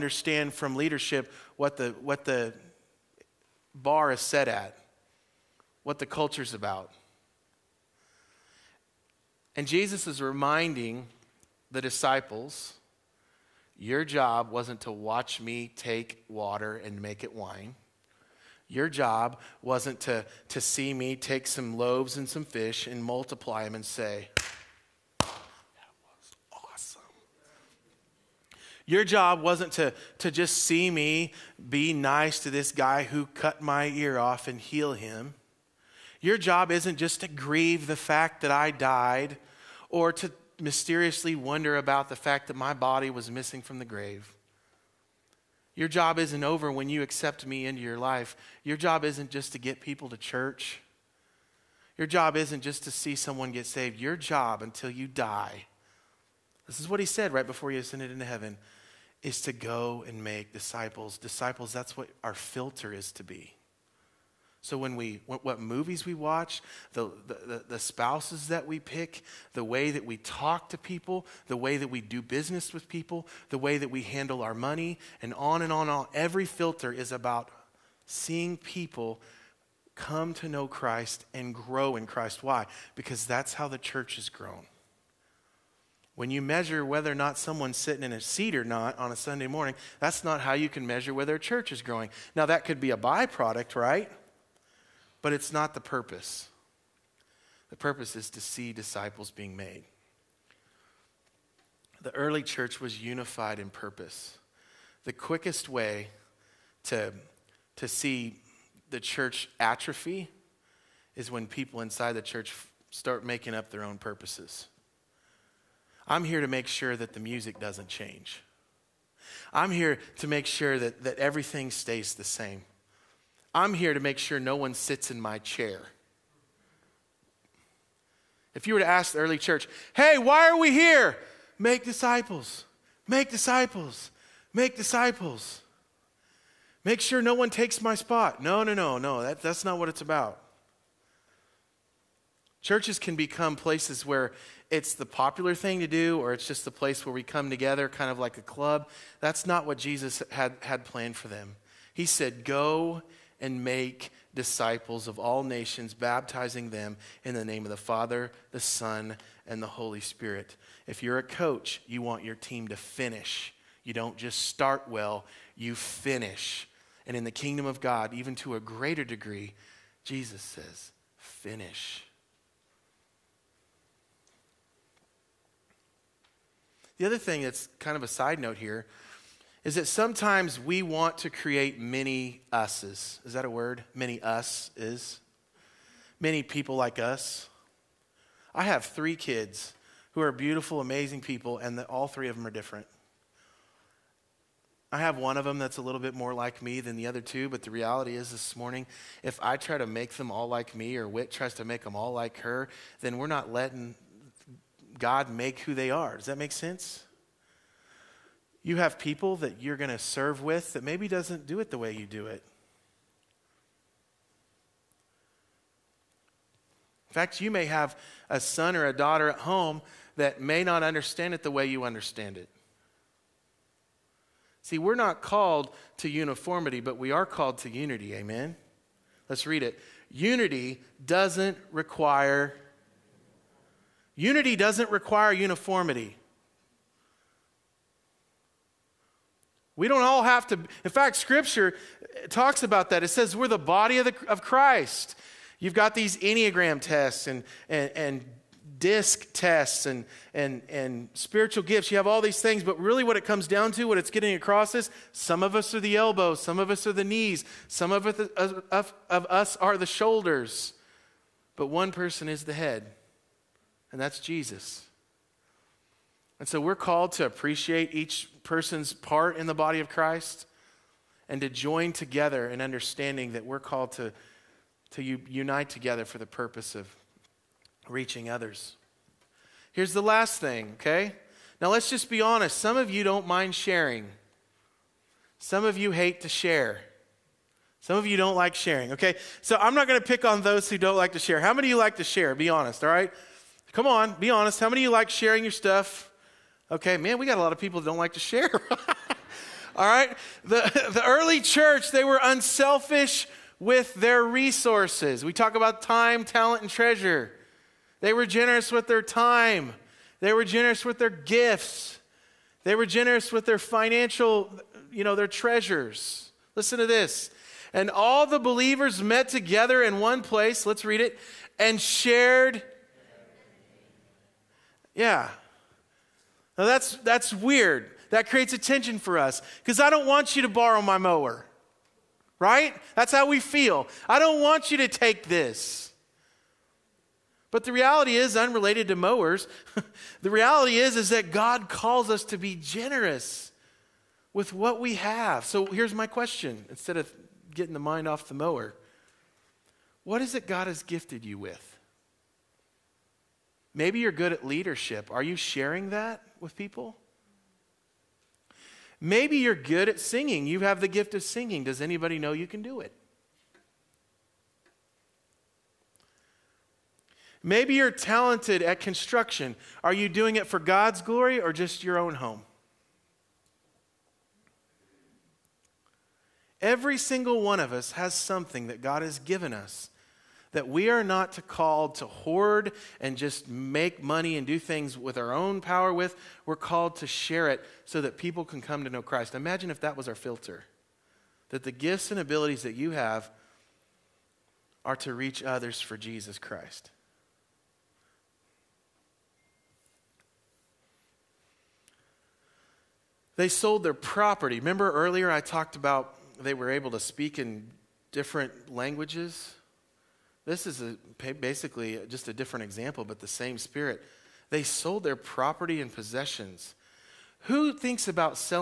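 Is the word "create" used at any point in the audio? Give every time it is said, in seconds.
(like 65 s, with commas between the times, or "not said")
181 s, 328 s.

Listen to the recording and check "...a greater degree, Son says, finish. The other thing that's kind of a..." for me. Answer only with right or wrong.
wrong.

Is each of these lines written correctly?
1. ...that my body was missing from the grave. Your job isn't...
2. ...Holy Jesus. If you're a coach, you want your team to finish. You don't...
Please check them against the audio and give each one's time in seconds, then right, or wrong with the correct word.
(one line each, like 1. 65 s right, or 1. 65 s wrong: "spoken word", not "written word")
1. 42 s right
2. 159 s wrong: "Spirit", not "Jesus".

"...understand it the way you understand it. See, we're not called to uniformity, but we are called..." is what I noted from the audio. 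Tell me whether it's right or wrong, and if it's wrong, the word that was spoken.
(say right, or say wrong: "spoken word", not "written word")
right.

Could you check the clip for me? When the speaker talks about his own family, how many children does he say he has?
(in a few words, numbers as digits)
3.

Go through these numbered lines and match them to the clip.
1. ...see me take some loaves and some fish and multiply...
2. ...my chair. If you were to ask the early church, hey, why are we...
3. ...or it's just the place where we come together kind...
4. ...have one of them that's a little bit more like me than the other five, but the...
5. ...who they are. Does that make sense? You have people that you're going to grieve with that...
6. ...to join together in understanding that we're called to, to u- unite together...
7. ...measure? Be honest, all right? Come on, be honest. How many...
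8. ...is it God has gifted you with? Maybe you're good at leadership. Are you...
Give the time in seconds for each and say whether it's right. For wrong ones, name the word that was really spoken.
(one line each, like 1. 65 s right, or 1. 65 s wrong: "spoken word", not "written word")
1. 20 s right
2. 125 s right
3. 146 s right
4. 194 s wrong: "two", not "five"
5. 205 s wrong: "serve", not "grieve"
6. 271 s right
7. 292 s wrong: "share", not "measure"
8. 350 s right.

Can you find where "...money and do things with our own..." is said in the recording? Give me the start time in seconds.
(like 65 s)
384 s.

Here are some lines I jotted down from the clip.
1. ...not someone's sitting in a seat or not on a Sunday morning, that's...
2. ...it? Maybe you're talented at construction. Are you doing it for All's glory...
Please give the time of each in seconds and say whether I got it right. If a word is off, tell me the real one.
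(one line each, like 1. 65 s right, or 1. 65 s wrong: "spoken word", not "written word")
1. 87 s right
2. 362 s wrong: "God", not "All".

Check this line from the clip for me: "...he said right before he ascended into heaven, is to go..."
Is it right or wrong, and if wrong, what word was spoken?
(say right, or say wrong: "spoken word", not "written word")
right.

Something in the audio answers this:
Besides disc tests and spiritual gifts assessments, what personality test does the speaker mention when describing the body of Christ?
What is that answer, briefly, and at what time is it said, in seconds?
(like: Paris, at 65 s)
Enneagram, at 246 s.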